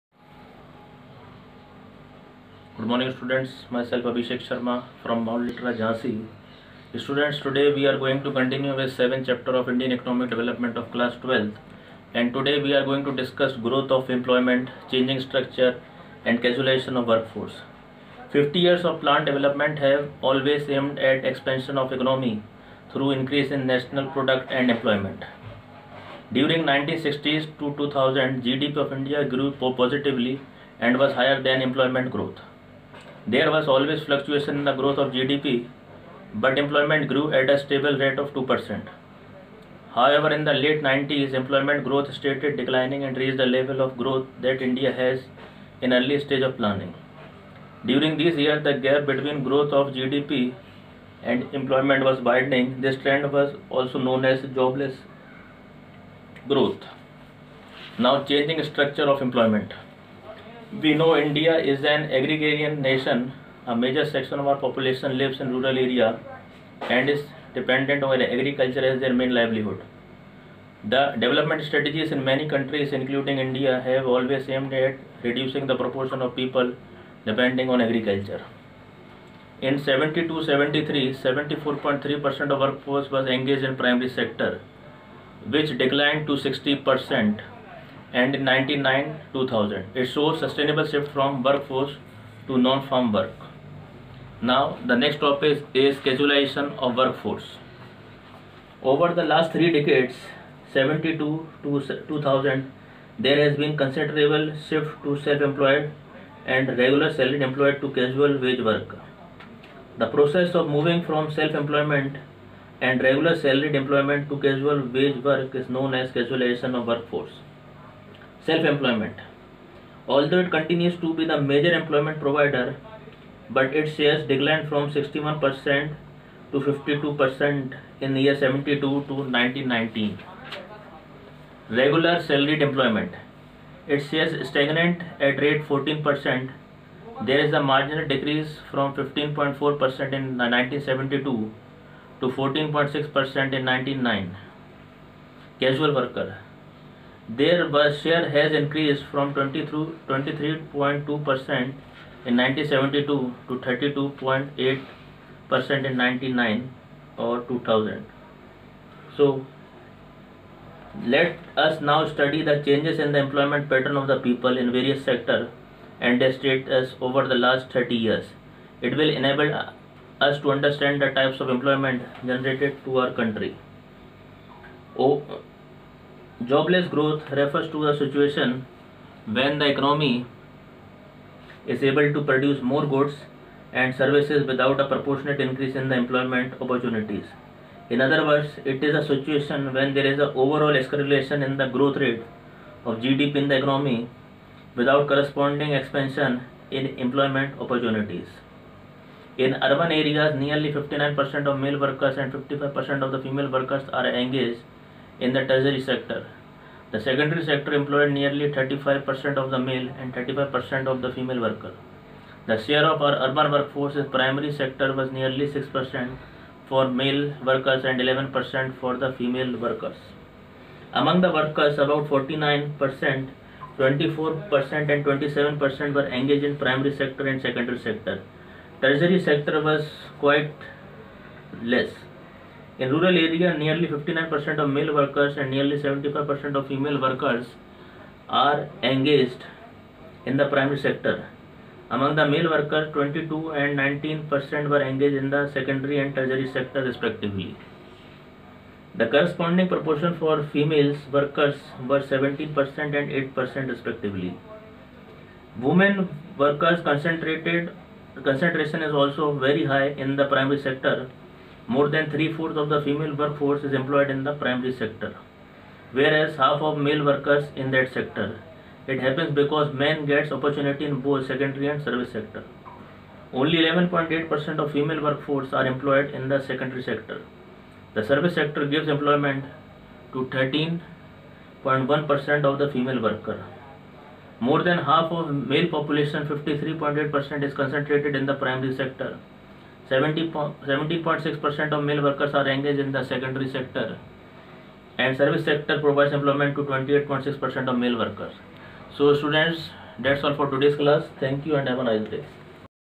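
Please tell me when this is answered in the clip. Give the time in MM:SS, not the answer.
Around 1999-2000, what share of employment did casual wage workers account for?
02:34.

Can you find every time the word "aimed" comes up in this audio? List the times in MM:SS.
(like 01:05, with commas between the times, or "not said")
00:20, 01:14.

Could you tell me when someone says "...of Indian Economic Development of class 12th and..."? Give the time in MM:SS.
00:09.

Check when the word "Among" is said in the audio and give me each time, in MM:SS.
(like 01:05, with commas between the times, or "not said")
03:40, 04:01.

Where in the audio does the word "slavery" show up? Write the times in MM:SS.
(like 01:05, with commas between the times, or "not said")
not said.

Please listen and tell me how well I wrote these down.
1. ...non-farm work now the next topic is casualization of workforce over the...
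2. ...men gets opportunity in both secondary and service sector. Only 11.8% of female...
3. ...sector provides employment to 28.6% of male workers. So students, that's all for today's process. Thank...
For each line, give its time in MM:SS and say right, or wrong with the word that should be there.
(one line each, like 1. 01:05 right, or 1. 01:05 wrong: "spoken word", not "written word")
1. 01:32 right
2. 04:29 right
3. 04:55 wrong: "class", not "process".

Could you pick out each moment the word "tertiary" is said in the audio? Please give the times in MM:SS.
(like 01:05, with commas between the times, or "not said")
03:25, 03:48, 04:06.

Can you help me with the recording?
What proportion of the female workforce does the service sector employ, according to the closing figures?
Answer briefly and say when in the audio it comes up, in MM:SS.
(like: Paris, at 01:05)
13.1%, at 04:40.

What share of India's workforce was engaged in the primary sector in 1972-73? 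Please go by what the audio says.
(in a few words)
74.3%.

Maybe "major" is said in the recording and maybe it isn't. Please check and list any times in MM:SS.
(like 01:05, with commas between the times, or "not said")
01:03, 02:01.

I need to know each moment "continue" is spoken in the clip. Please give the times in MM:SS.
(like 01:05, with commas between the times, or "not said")
00:08, 02:00.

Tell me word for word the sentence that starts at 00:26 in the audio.
During 1960s to 2000, GDP of India grew positively and was higher than employment growth.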